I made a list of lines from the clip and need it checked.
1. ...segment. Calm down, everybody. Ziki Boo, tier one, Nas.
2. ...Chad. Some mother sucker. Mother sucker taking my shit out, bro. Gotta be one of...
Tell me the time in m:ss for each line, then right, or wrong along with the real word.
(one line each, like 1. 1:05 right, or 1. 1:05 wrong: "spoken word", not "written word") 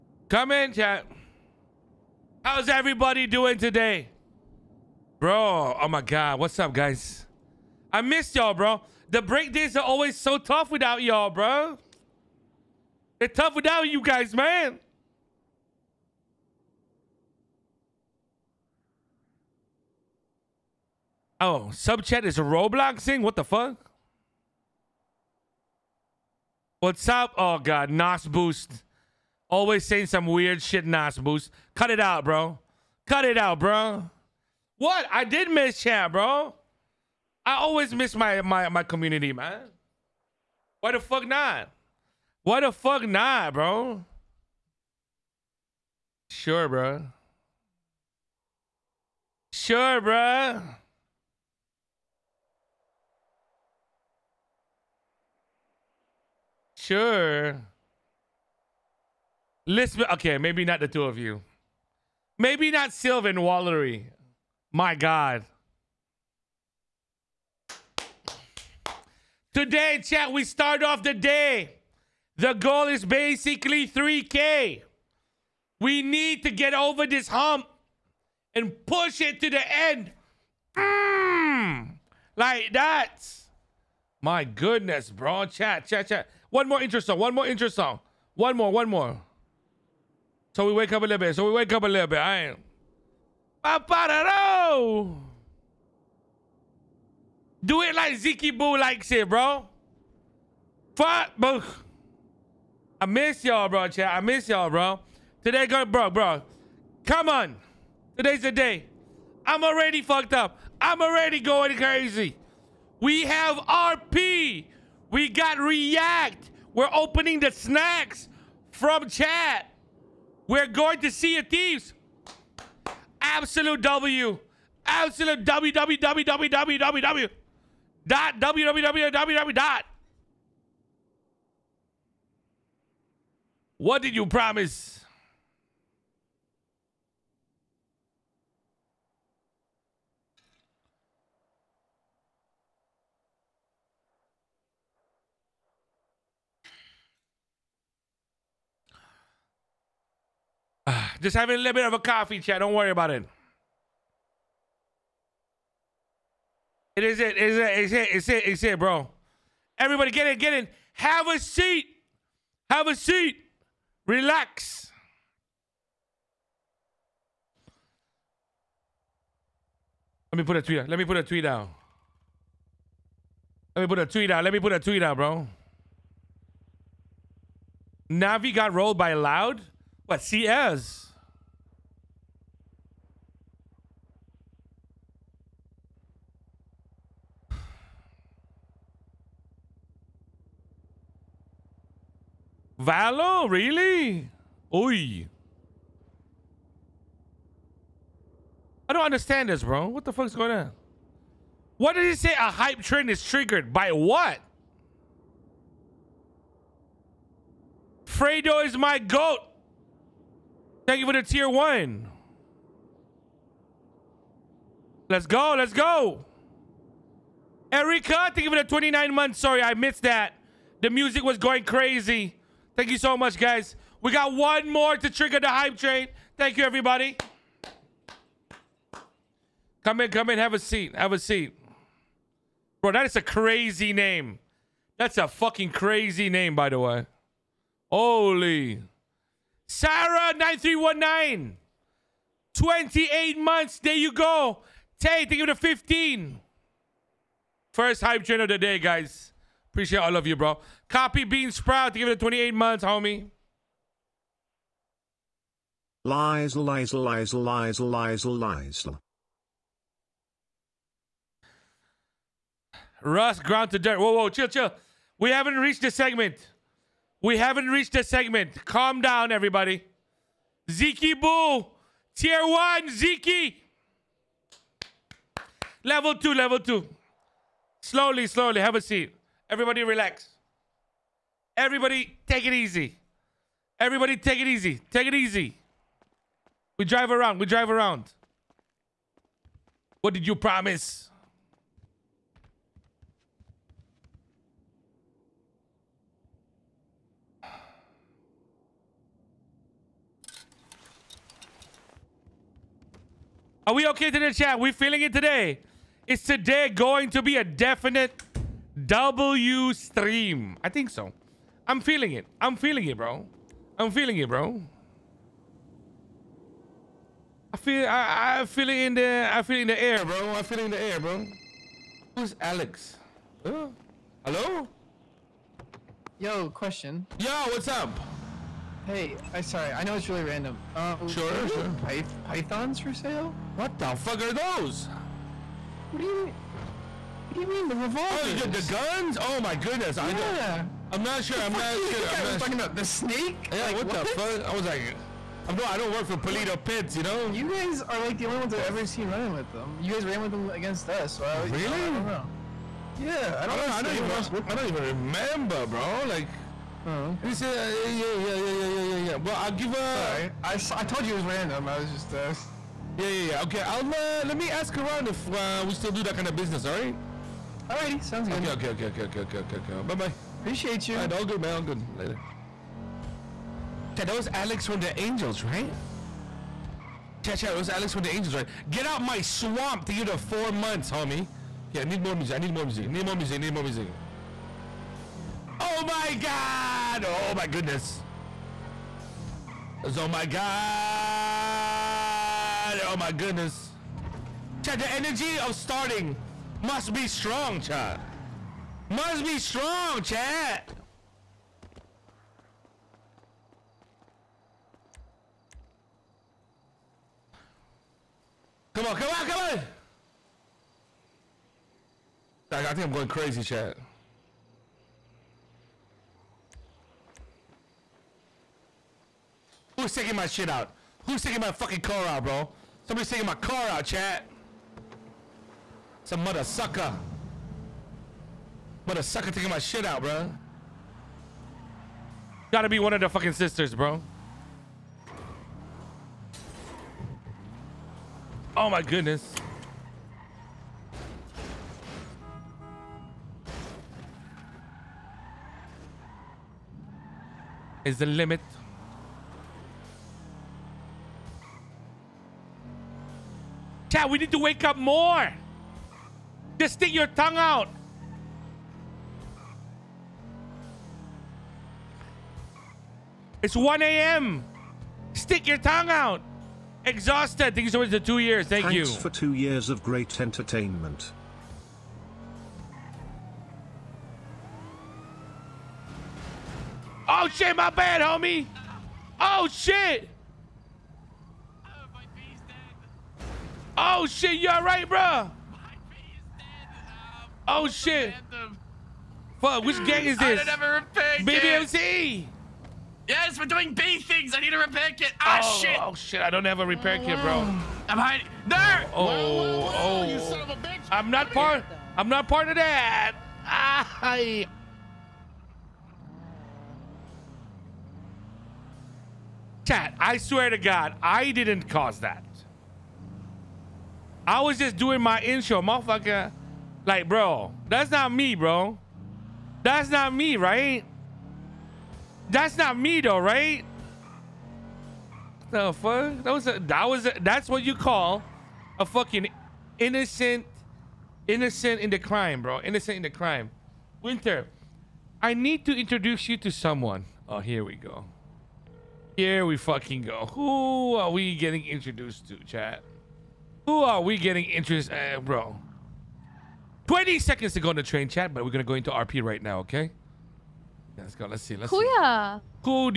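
1. 4:28 wrong: "Ziki", not "Nas"
2. 7:03 right.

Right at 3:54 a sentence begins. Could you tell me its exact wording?
That's a fucking crazy name, by the way.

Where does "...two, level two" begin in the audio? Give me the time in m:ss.
4:36.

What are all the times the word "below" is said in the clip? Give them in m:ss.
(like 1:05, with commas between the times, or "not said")
not said.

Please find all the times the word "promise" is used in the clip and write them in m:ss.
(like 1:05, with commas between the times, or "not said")
2:14, 4:50.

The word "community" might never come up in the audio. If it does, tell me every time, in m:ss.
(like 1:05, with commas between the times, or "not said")
0:38.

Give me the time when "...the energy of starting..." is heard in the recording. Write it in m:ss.
6:34.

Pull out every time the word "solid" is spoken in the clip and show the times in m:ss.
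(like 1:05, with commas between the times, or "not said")
not said.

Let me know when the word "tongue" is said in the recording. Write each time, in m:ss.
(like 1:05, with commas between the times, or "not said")
7:37, 7:45.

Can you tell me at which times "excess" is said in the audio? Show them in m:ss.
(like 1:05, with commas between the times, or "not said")
not said.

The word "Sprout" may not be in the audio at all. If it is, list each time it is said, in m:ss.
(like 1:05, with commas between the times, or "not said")
4:11.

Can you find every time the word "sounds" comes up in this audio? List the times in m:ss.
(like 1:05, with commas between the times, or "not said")
6:08.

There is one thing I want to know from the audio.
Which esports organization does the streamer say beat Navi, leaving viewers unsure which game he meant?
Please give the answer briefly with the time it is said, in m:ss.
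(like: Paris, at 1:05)
Loud, at 2:59.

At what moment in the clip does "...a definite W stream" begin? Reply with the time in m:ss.
5:07.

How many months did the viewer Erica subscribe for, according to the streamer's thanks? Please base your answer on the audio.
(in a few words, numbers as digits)
29.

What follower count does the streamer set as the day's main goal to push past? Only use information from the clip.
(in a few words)
3K.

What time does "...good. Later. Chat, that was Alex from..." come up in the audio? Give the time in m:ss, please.
6:11.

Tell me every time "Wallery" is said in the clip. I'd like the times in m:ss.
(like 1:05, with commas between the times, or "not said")
1:03.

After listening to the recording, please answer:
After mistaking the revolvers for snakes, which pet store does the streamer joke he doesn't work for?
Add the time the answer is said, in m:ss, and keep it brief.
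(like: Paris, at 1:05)
Polito Pets, at 5:46.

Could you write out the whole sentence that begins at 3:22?
A hype trend is triggered by what?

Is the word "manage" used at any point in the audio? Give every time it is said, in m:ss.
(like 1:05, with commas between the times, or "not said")
not said.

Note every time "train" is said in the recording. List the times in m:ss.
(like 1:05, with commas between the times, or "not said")
3:45, 4:08, 9:07.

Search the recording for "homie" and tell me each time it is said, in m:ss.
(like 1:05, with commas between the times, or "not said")
4:12, 6:20, 7:57.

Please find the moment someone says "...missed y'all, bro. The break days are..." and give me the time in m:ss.
0:08.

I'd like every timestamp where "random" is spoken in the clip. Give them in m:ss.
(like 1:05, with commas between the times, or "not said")
5:30, 6:01.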